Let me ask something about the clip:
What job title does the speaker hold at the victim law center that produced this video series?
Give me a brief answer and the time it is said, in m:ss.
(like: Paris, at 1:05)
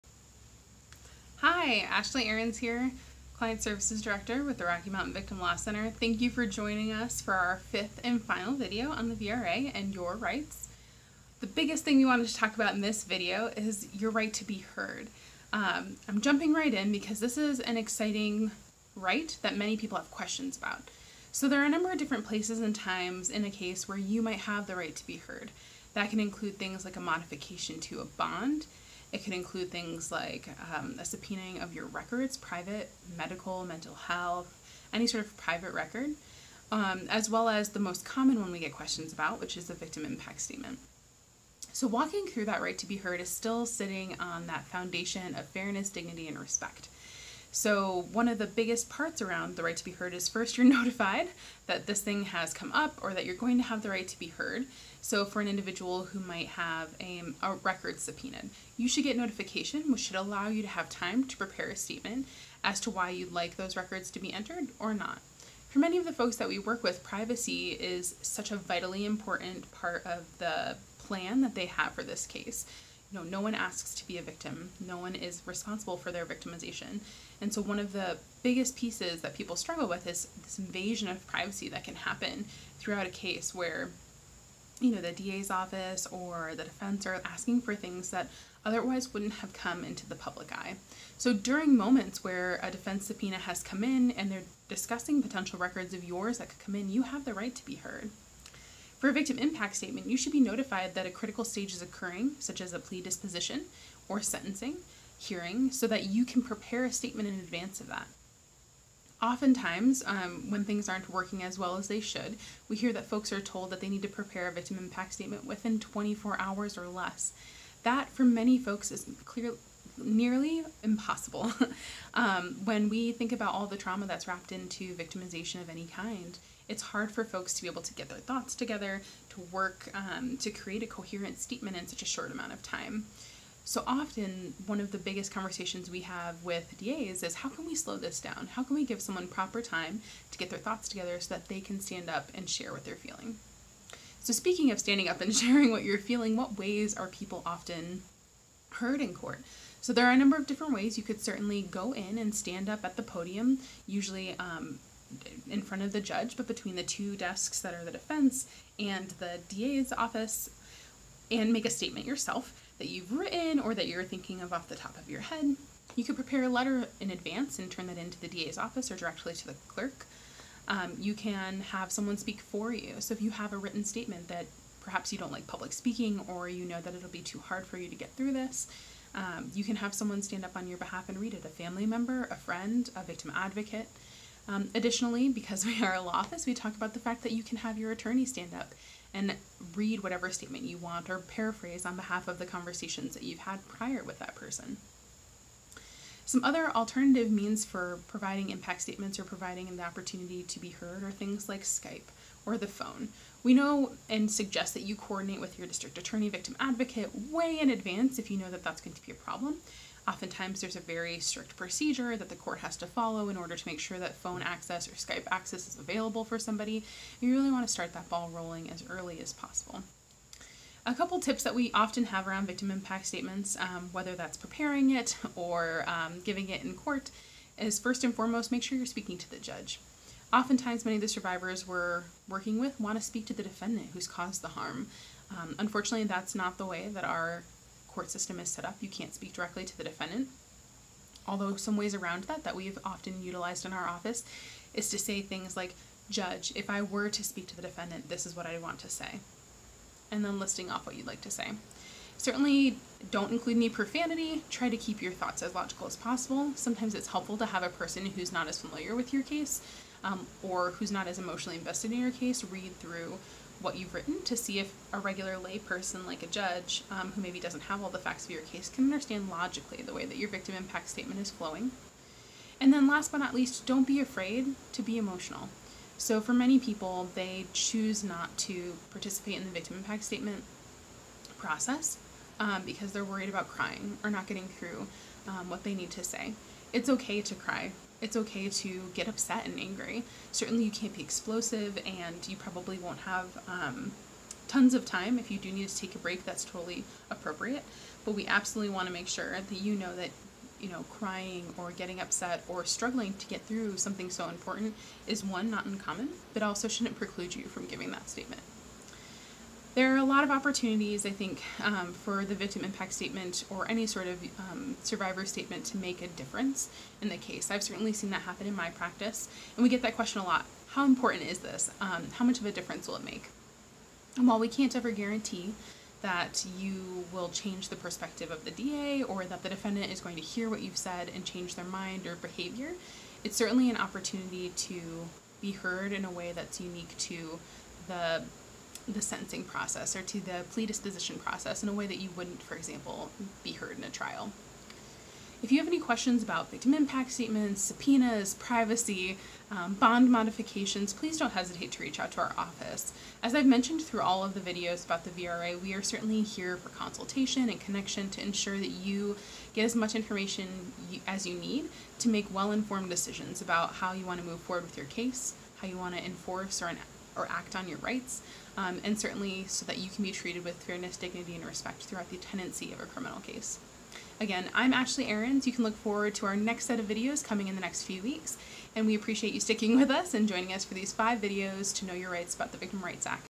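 Client Services Director, at 0:03.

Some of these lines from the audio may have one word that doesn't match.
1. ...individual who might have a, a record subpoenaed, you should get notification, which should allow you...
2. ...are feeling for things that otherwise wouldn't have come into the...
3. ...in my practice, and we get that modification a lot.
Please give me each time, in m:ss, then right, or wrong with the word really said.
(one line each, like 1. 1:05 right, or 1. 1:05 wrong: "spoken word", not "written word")
1. 0:55 right
2. 1:27 wrong: "asking", not "feeling"
3. 5:18 wrong: "question", not "modification".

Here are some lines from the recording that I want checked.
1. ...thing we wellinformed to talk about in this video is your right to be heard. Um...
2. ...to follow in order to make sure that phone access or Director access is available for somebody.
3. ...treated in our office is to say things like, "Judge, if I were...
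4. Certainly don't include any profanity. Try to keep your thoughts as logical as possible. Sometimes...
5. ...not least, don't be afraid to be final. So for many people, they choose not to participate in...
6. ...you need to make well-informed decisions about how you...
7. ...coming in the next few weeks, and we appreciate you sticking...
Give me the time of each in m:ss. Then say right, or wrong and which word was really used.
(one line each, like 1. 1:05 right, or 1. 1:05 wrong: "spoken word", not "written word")
1. 0:11 wrong: "wanted", not "wellinformed"
2. 3:32 wrong: "Skype", not "Director"
3. 4:03 wrong: "utilized", not "treated"
4. 4:12 right
5. 4:33 wrong: "emotional", not "final"
6. 6:01 right
7. 6:17 right.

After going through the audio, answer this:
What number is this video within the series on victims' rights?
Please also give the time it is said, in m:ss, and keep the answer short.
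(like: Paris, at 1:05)
Fifth, at 0:07.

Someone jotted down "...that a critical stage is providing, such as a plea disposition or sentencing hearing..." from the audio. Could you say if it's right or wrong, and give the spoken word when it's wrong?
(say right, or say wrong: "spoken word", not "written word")
wrong: "occurring", not "providing".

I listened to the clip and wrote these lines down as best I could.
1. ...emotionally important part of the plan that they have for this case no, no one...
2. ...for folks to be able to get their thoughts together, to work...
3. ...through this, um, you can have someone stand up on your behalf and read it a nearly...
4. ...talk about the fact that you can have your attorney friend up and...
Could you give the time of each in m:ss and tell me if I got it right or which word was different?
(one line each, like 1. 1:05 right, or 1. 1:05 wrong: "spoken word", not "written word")
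1. 1:08 wrong: "vitally", not "emotionally"
2. 2:07 right
3. 2:58 wrong: "family", not "nearly"
4. 3:06 wrong: "stand", not "friend".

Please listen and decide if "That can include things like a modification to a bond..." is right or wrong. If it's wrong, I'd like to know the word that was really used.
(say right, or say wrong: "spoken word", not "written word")
right.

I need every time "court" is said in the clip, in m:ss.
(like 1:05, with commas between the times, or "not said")
2:29, 3:32, 3:46, 3:57.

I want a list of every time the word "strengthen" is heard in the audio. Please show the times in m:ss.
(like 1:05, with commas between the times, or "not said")
not said.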